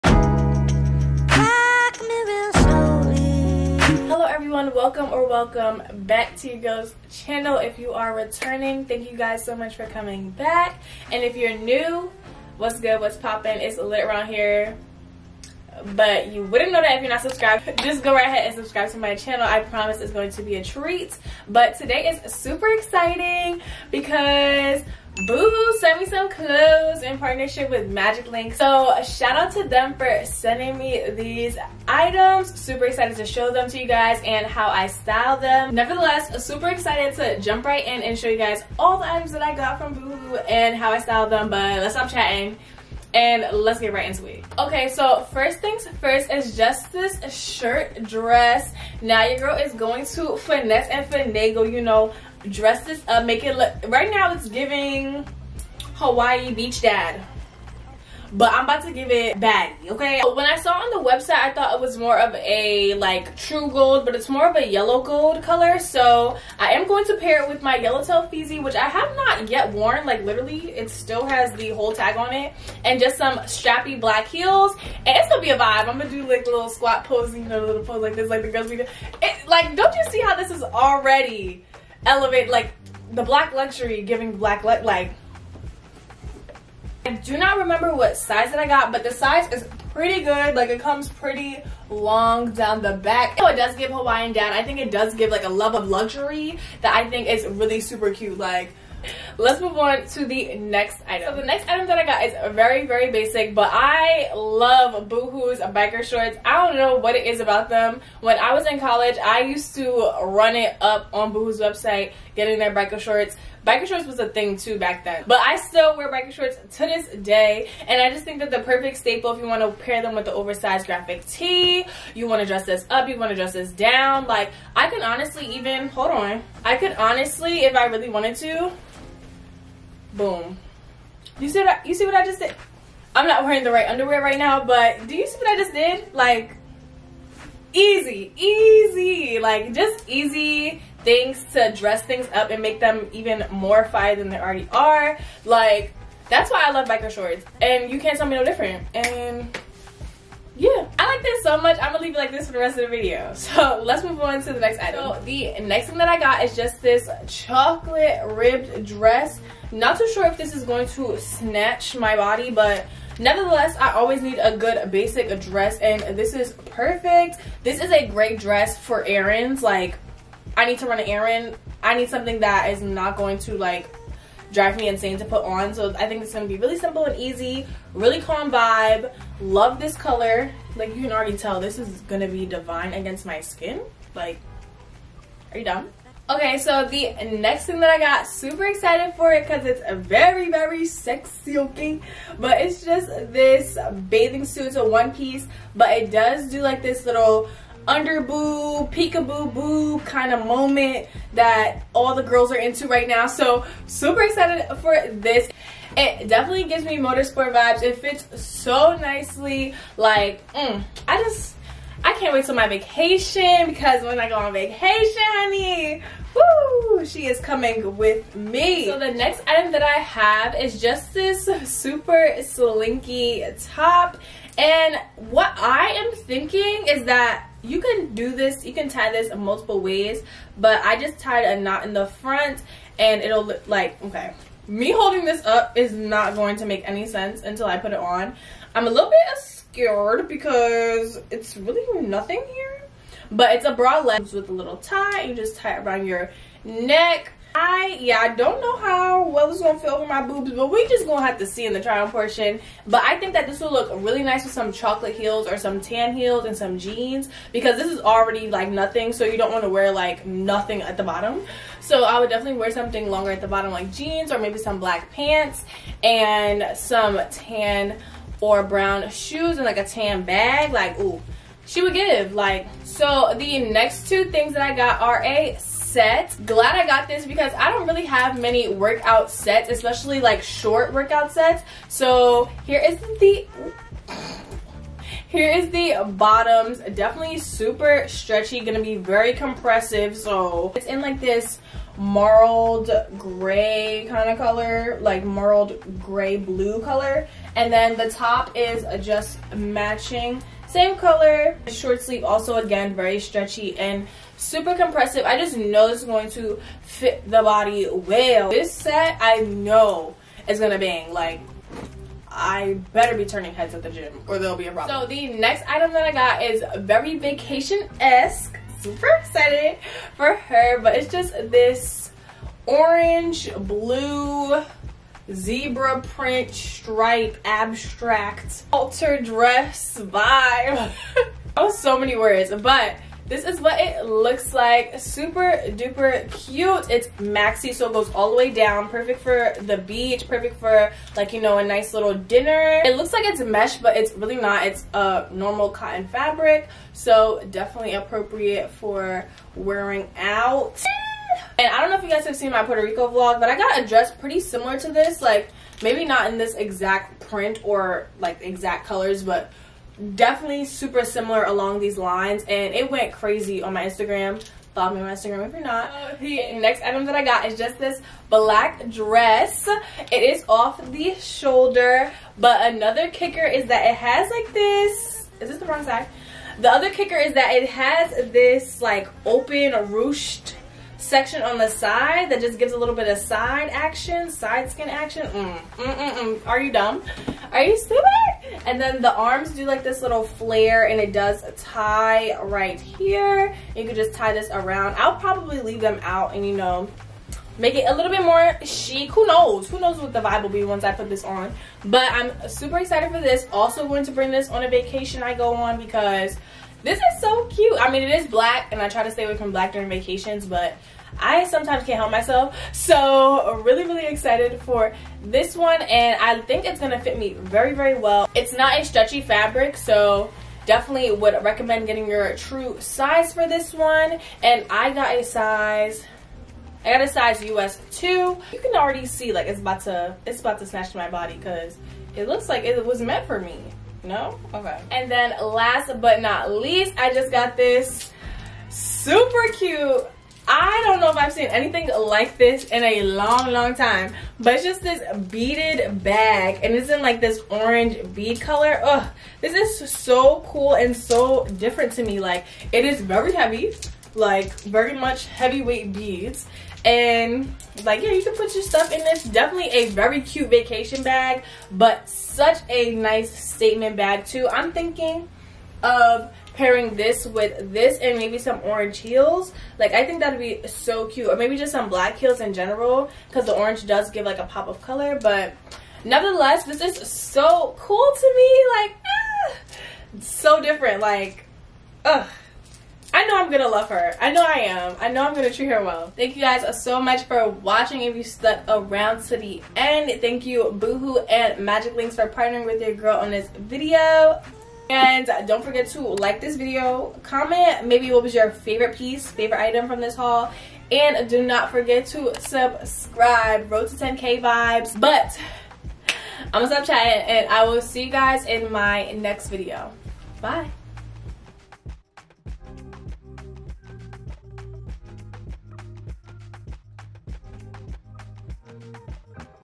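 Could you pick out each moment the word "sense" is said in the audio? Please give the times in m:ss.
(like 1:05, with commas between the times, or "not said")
3:57.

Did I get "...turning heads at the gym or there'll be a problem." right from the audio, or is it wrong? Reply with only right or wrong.
right.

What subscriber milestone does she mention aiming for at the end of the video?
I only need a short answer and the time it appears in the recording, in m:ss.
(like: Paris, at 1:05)
10K, at 8:23.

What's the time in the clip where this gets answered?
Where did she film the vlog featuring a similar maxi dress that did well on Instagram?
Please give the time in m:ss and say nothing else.
5:52.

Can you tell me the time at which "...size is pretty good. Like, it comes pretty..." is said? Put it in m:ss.
1:29.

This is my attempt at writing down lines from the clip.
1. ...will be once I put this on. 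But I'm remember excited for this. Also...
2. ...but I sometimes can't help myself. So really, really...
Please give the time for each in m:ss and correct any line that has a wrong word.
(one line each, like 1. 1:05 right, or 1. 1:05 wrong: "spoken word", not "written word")
1. 6:40 wrong: "super", not "remember"
2. 6:50 right.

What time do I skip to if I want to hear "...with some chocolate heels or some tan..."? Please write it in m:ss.
4:14.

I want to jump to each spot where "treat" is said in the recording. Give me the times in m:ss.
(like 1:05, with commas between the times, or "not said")
0:20, 8:05.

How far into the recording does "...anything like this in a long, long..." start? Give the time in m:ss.
7:21.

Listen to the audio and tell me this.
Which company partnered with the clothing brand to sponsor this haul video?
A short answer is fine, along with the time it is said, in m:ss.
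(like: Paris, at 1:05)
Magic Link, at 0:27.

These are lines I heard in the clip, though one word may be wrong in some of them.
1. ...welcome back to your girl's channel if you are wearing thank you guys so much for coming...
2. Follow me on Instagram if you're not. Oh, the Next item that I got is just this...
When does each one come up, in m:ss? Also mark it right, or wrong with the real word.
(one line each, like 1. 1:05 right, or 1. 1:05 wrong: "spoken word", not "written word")
1. 0:05 wrong: "returning", not "wearing"
2. 6:04 right.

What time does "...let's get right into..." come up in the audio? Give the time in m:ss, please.
0:43.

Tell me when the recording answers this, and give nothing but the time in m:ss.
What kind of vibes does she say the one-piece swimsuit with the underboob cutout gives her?
3:26.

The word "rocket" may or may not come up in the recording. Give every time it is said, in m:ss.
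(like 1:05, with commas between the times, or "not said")
not said.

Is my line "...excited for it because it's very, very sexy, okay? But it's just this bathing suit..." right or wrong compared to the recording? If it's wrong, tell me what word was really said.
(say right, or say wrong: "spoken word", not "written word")
right.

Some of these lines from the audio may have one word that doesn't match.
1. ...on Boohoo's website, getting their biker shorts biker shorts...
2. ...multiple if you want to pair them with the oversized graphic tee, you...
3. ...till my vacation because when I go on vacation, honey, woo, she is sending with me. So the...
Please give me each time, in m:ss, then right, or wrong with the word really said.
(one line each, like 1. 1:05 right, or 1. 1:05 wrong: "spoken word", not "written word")
1. 1:51 right
2. 1:58 wrong: "staple", not "multiple"
3. 3:32 wrong: "coming", not "sending".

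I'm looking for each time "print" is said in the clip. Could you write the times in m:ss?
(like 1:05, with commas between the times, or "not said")
5:26, 5:57.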